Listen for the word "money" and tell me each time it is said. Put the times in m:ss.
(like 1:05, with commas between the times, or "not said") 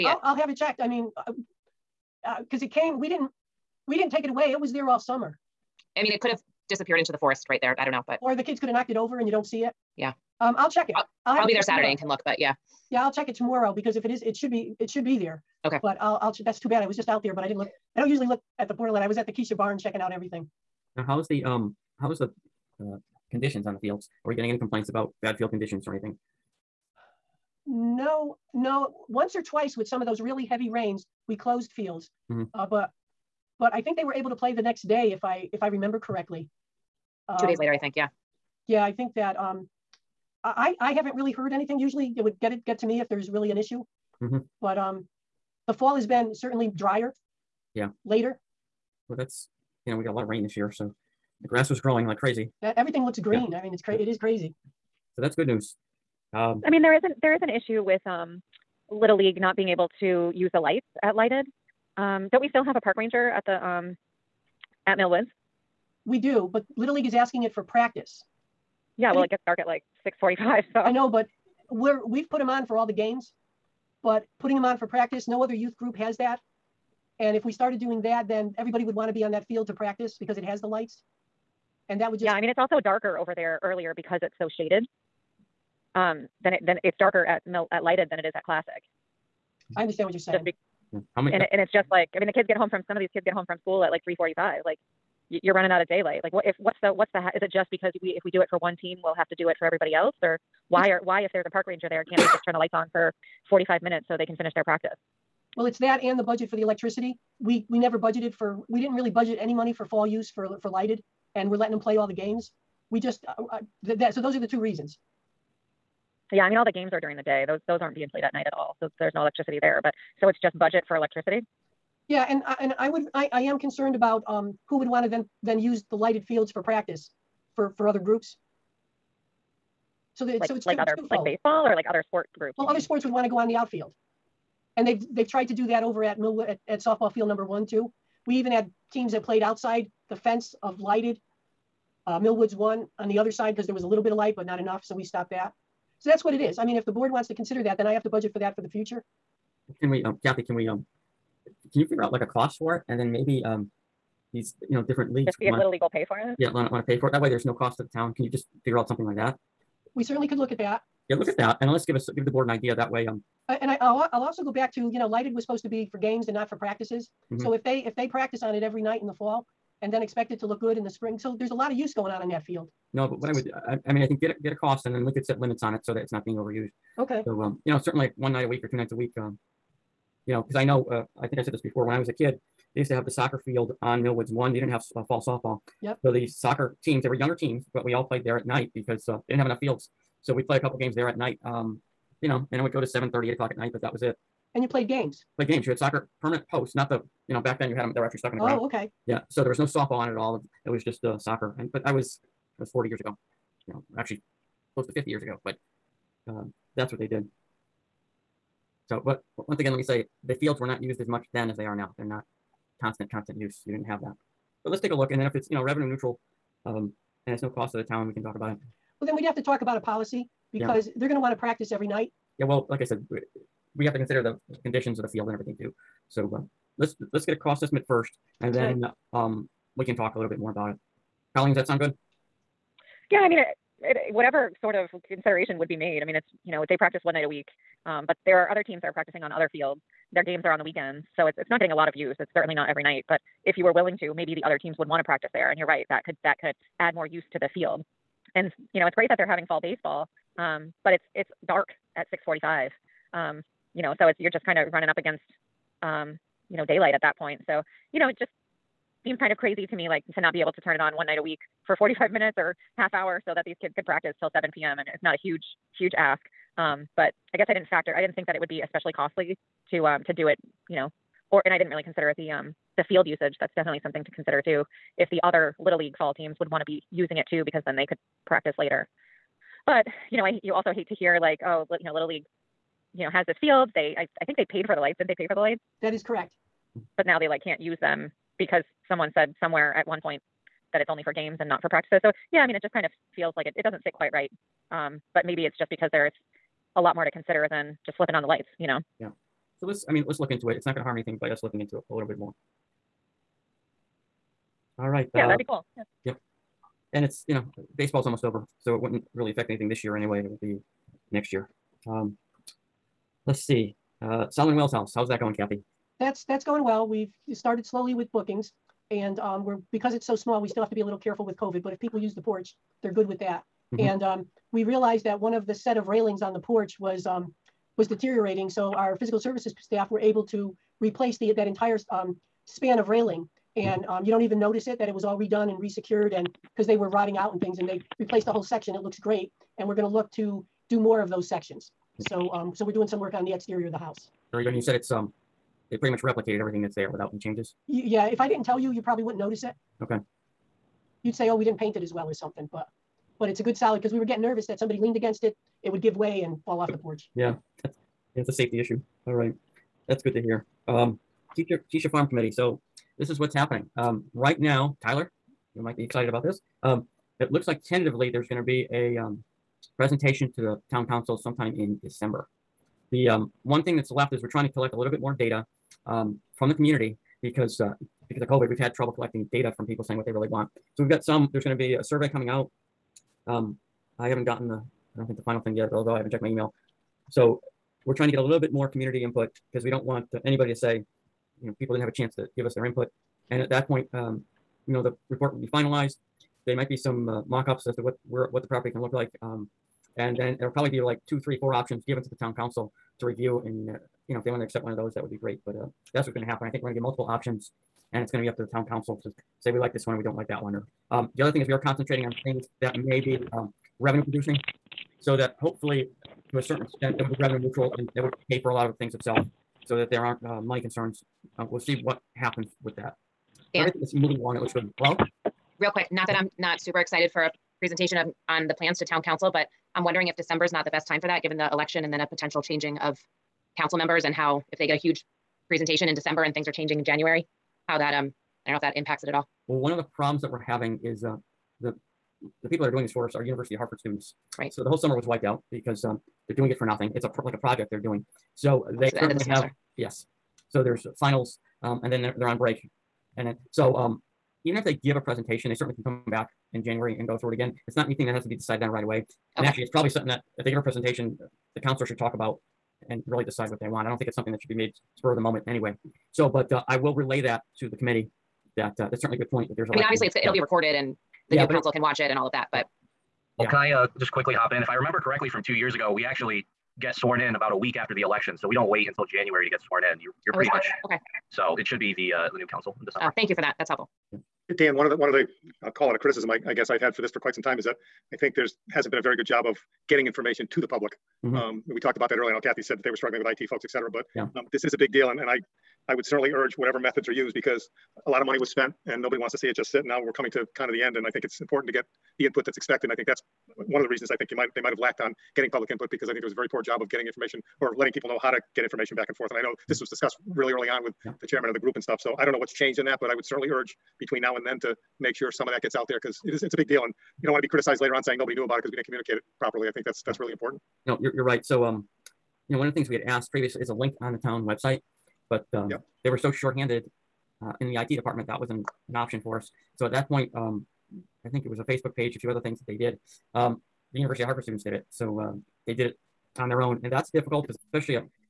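1:49, 7:00, 8:18.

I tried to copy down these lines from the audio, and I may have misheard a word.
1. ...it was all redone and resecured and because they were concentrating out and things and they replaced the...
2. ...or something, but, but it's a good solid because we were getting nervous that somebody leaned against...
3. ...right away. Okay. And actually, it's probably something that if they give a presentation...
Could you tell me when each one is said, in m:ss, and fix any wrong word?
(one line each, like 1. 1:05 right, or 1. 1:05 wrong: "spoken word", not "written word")
1. 5:34 wrong: "rotting", not "concentrating"
2. 5:52 right
3. 7:38 right.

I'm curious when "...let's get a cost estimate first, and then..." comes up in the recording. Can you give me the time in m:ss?
3:47.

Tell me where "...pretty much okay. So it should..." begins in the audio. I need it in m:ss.
8:00.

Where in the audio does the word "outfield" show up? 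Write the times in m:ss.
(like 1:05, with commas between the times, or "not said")
2:13.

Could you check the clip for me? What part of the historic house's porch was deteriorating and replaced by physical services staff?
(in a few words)
railings.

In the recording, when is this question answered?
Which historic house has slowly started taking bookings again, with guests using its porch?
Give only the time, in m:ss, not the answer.
5:14.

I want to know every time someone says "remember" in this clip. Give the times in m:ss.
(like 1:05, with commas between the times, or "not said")
0:35, 7:54.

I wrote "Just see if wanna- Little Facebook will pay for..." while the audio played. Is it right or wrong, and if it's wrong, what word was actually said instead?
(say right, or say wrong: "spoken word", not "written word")
wrong: "League", not "Facebook".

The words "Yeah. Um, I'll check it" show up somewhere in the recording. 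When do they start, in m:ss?
0:09.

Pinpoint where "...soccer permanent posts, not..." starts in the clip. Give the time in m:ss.
3:15.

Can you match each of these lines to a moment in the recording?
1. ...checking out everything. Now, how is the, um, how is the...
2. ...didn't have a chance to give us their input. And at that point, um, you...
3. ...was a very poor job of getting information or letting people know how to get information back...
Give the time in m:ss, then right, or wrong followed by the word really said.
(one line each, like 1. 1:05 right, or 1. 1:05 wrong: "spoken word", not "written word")
1. 0:19 right
2. 6:31 right
3. 8:26 right.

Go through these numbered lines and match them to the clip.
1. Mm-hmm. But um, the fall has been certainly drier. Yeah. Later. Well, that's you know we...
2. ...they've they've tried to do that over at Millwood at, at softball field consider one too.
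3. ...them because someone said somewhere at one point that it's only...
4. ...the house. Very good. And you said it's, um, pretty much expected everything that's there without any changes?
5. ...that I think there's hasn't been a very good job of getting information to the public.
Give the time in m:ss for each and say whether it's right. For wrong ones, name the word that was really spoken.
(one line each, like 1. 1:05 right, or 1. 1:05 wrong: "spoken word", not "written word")
1. 0:44 right
2. 2:14 wrong: "number", not "consider"
3. 4:47 right
4. 5:43 wrong: "replicated", not "expected"
5. 8:07 right.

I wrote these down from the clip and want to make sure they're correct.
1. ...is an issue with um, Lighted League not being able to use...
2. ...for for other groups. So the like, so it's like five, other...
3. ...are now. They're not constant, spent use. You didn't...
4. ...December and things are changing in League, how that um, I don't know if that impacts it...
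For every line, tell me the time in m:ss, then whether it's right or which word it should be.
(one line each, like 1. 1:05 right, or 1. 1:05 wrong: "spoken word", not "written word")
1. 0:57 wrong: "Little", not "Lighted"
2. 2:07 wrong: "two", not "five"
3. 3:31 wrong: "constant", not "spent"
4. 7:15 wrong: "January", not "League".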